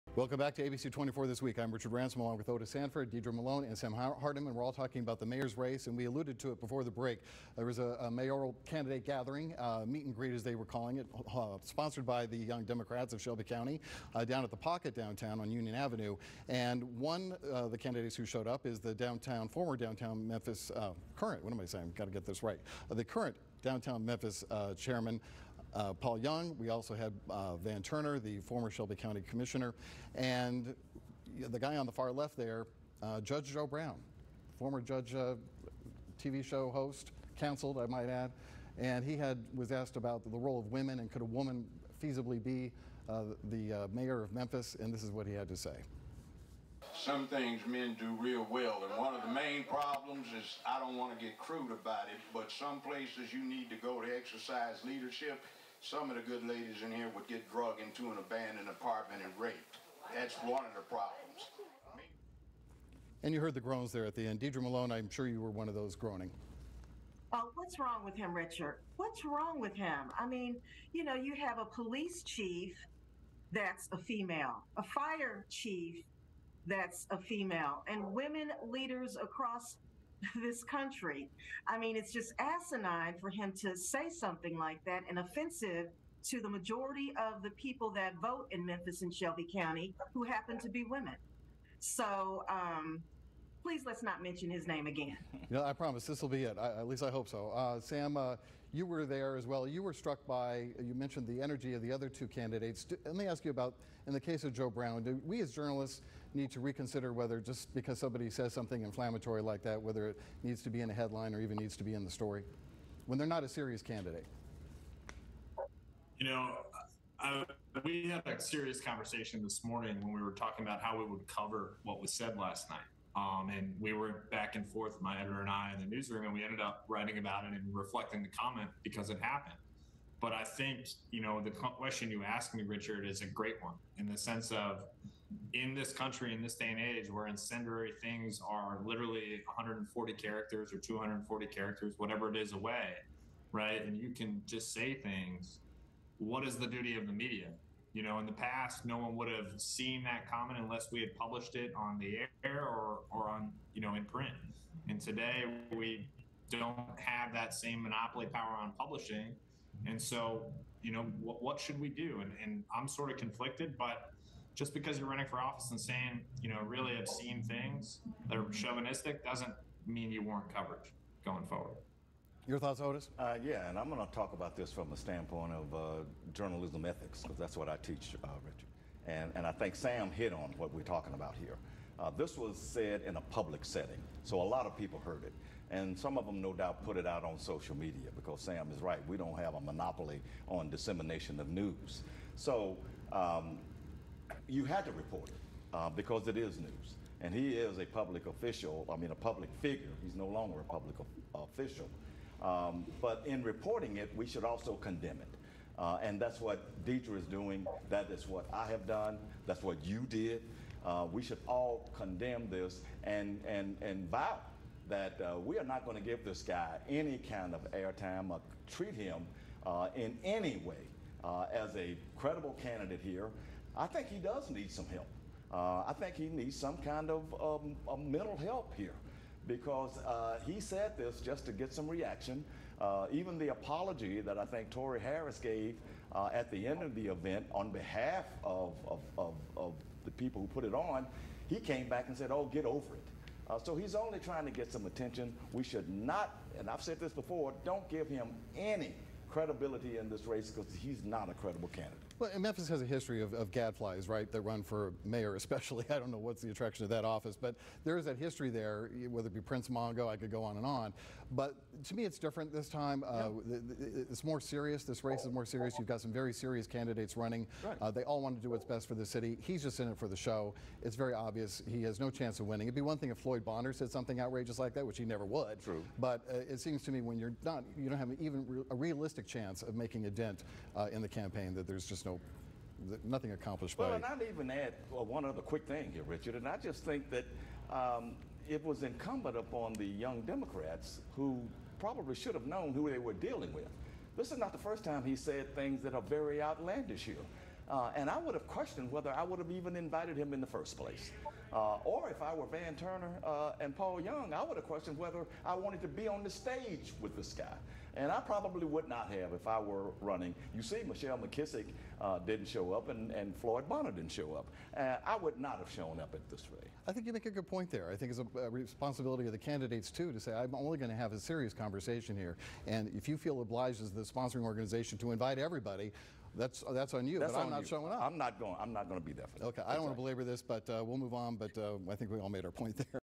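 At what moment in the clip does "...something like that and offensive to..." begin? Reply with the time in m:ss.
1:24.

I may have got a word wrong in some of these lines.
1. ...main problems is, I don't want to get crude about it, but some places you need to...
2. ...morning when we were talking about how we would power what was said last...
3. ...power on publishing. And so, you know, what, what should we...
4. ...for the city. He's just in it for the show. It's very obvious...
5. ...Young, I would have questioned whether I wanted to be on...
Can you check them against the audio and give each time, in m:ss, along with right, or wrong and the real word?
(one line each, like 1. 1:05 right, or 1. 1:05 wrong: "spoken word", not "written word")
1. 0:49 right
2. 1:59 wrong: "cover", not "power"
3. 2:38 right
4. 4:28 right
5. 5:04 right.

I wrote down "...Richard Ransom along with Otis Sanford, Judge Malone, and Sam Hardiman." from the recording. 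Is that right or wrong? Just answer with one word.
wrong.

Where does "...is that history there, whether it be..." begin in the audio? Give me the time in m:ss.
4:17.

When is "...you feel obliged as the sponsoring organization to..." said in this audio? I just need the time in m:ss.
5:23.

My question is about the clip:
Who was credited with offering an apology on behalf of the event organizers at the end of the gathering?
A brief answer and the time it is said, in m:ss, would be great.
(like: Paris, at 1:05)
Tory Harris, at 3:54.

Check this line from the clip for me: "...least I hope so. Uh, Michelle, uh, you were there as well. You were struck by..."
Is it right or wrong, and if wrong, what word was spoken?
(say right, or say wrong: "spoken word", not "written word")
wrong: "Sam", not "Michelle".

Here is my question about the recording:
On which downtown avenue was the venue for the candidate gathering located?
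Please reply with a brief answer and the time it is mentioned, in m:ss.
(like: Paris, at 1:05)
Union Avenue, at 0:15.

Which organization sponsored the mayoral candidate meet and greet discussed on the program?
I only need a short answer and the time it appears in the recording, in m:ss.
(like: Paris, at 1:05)
Young Democrats of Shelby County, at 0:12.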